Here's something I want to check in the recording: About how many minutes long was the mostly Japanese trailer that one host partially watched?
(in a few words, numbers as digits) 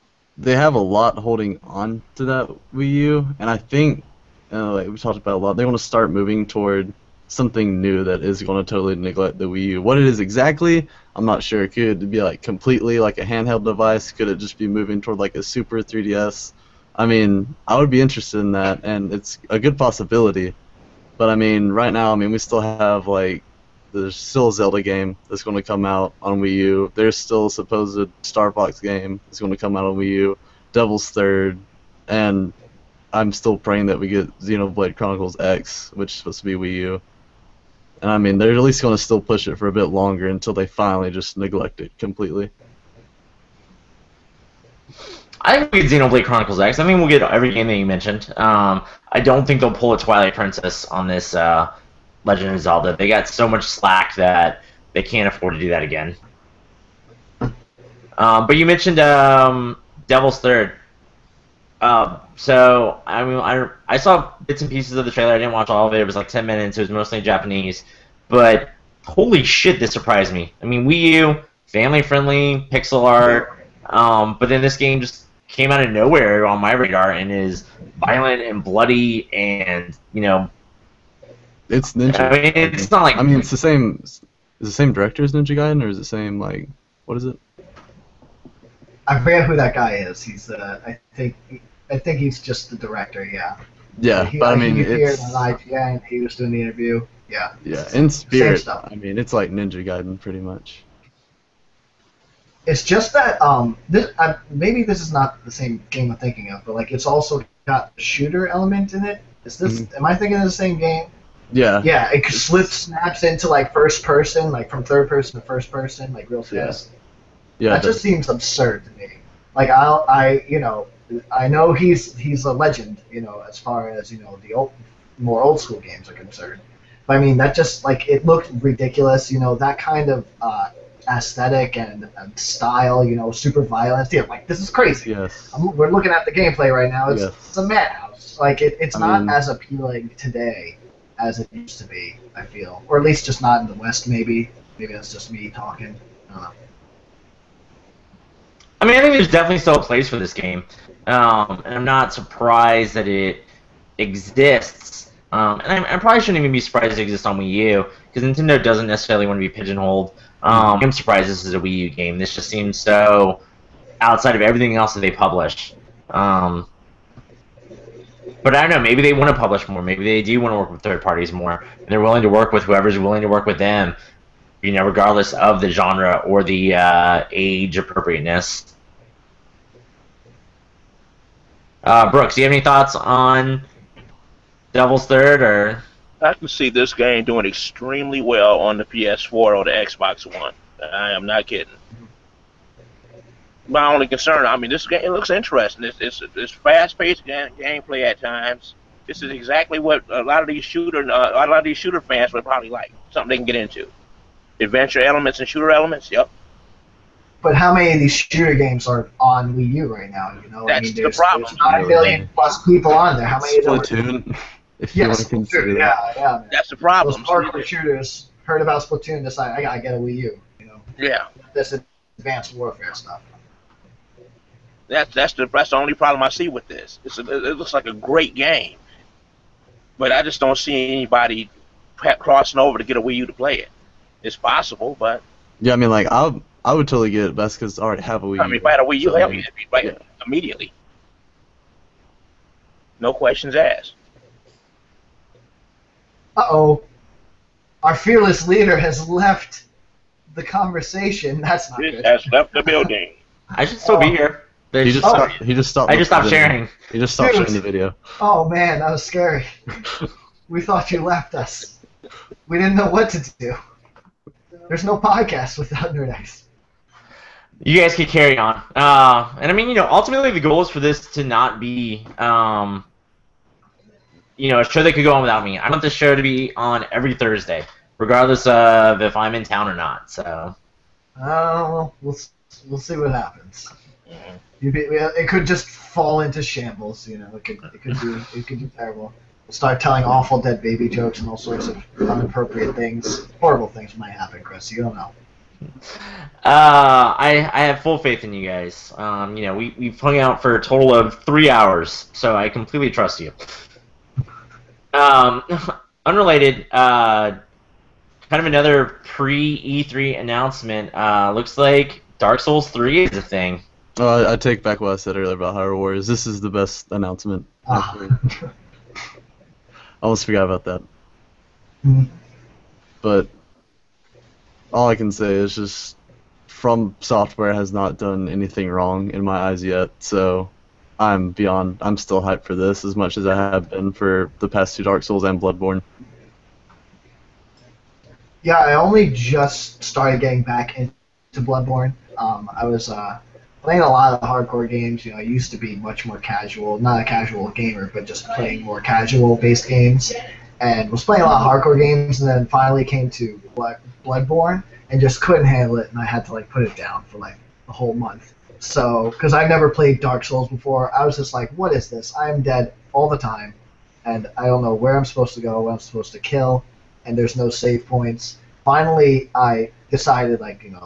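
10.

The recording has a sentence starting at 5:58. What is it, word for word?
So, because I've never played Dark Souls before, I was just like, "What is this?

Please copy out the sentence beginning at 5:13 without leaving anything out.
Uh, I take back what I said earlier about Hyrule Warriors.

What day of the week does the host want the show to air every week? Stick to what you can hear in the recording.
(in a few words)
Thursday.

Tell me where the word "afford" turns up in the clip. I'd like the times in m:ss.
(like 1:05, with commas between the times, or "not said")
0:55.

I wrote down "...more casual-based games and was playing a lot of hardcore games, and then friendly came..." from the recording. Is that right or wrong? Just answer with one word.
wrong.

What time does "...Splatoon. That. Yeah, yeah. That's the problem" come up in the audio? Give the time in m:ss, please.
3:35.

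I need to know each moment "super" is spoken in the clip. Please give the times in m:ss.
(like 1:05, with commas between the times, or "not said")
0:15, 2:13.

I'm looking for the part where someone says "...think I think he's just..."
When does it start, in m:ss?
1:31.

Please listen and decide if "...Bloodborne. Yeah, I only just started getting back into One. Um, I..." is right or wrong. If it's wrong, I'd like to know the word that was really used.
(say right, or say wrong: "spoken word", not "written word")
wrong: "Bloodborne", not "One".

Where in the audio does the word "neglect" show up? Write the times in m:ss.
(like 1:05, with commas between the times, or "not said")
0:08, 0:41.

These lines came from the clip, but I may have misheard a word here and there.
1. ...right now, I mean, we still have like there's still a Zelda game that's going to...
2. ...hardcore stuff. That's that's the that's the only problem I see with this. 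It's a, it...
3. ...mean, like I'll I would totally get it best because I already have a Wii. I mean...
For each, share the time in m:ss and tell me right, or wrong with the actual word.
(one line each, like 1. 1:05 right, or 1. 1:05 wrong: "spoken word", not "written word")
1. 0:21 right
2. 3:42 wrong: "warfare", not "hardcore"
3. 3:55 right.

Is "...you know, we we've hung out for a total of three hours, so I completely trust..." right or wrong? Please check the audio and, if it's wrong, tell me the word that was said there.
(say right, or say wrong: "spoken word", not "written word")
right.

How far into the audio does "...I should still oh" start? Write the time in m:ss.
4:13.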